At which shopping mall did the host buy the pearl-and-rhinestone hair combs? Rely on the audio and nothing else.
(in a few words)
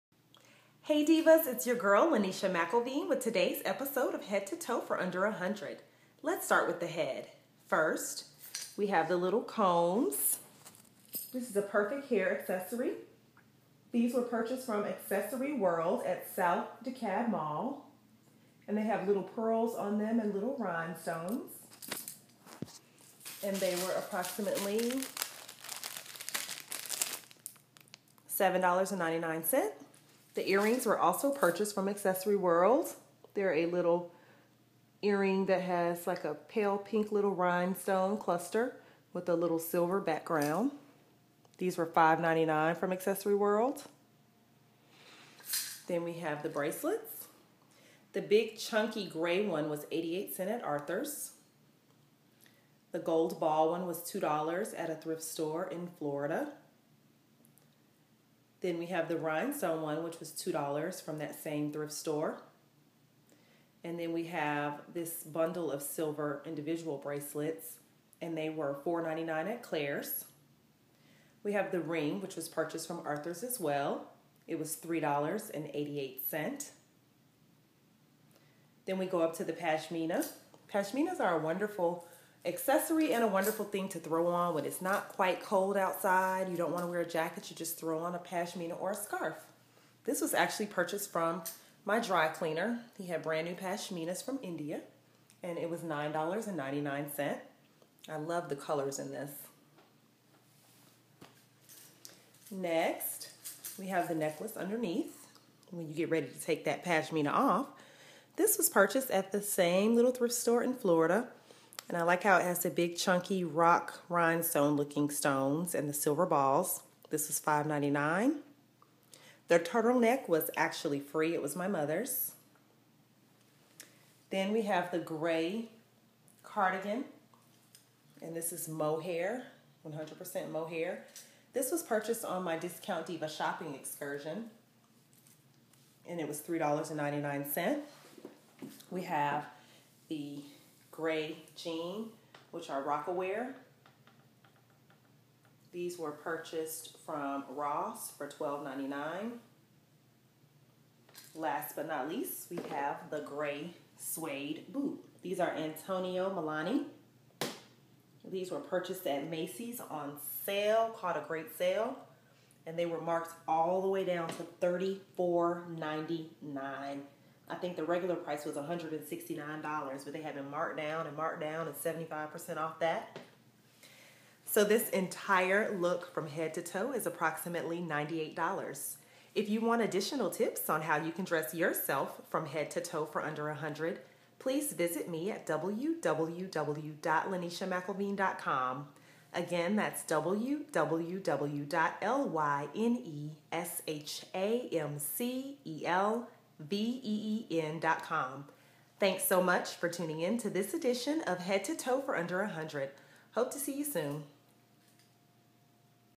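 South DeKalb Mall.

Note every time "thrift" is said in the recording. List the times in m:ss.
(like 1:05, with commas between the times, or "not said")
0:54, 1:01, 1:50.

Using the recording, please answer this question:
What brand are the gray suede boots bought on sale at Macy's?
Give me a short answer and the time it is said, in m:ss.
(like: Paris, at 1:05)
Antonio Melani, at 2:35.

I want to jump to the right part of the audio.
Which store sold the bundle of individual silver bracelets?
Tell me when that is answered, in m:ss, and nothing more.
1:09.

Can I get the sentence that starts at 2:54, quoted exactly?
So this entire look from head to toe is approximately $98.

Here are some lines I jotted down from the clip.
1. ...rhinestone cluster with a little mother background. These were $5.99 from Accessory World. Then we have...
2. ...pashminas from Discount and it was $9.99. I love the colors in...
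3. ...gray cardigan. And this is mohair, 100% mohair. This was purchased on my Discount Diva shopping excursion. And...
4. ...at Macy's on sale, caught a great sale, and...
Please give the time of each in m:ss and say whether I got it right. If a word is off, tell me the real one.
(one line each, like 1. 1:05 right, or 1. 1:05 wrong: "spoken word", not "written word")
1. 0:37 wrong: "silver", not "mother"
2. 1:33 wrong: "India", not "Discount"
3. 2:04 right
4. 2:39 right.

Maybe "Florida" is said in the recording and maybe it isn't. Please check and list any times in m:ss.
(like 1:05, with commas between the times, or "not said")
0:55, 1:50.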